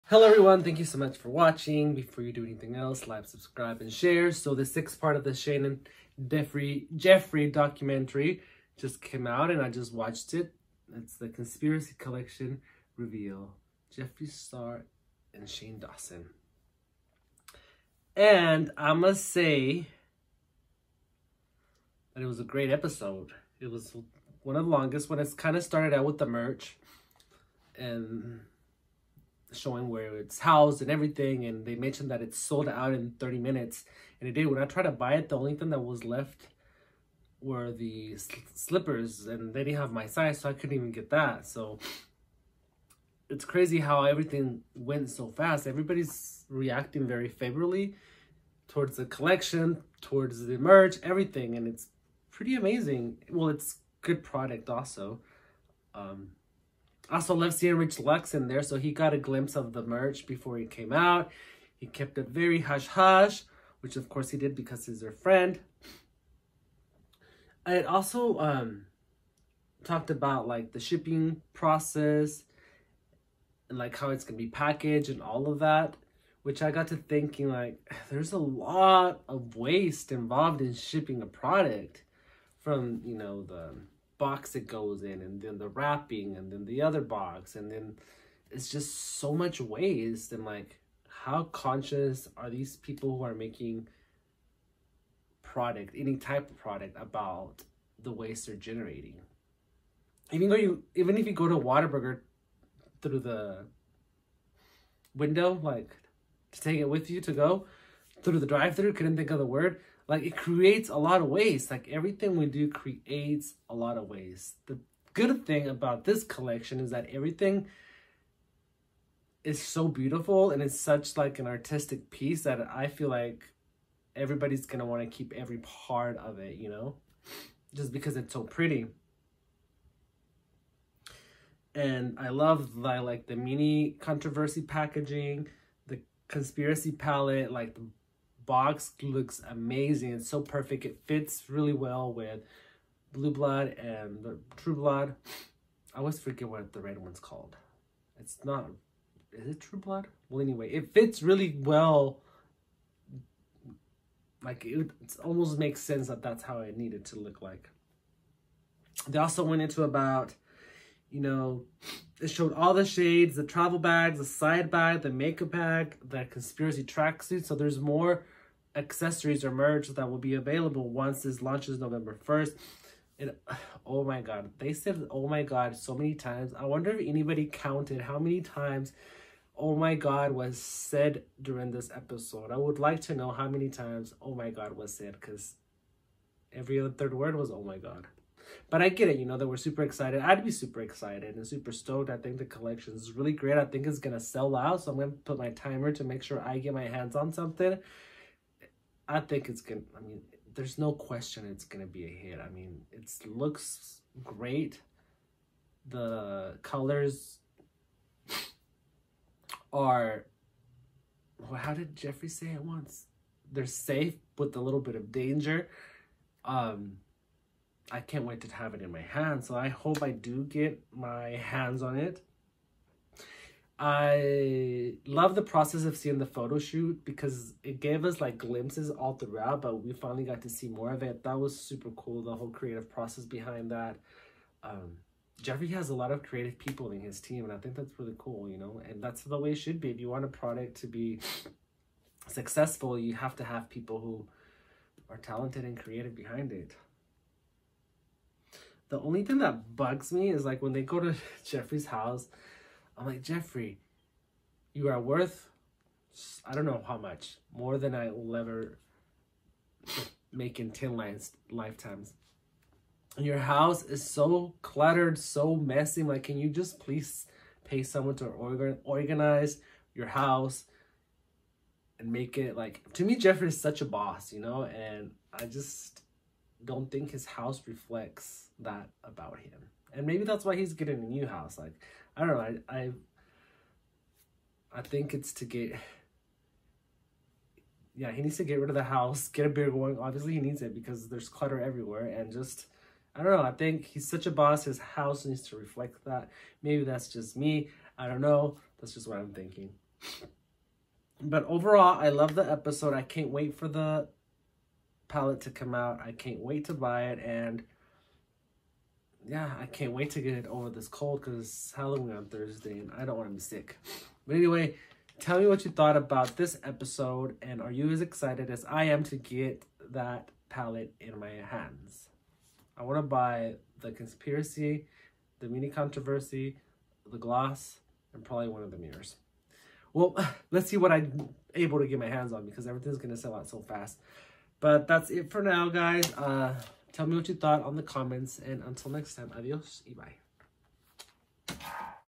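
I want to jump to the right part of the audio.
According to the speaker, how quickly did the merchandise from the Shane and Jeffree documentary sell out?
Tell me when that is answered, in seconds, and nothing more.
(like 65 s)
33 s.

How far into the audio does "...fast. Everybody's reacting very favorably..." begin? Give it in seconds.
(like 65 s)
45 s.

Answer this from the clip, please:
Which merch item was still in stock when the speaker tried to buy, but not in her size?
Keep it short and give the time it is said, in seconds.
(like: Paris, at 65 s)
The slippers, at 37 s.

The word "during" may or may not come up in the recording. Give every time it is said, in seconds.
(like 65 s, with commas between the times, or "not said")
181 s.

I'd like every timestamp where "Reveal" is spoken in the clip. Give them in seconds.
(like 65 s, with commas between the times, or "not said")
12 s.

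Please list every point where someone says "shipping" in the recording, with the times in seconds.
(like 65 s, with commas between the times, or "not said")
70 s, 80 s.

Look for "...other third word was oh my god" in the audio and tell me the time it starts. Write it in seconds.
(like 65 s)
186 s.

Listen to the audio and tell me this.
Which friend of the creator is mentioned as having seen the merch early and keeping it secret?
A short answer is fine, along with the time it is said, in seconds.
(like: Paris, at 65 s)
Rich Lux, at 57 s.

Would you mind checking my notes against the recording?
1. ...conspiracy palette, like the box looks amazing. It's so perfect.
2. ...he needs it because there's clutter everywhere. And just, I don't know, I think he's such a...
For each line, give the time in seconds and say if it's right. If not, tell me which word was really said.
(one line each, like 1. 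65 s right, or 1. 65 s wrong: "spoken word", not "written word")
1. 136 s right
2. 290 s right.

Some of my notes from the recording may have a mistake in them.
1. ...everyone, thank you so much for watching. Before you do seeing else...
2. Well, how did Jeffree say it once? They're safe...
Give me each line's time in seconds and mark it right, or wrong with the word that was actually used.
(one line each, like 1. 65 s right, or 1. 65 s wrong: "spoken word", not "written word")
1. 0 s wrong: "anything", not "seeing"
2. 211 s right.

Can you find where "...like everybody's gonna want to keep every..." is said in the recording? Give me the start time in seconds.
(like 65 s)
123 s.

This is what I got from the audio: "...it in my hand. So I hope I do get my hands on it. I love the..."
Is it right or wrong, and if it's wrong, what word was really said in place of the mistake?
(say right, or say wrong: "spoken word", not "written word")
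right.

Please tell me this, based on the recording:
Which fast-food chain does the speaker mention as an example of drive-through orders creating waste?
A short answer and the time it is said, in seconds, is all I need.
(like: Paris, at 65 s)
Whataburger, at 101 s.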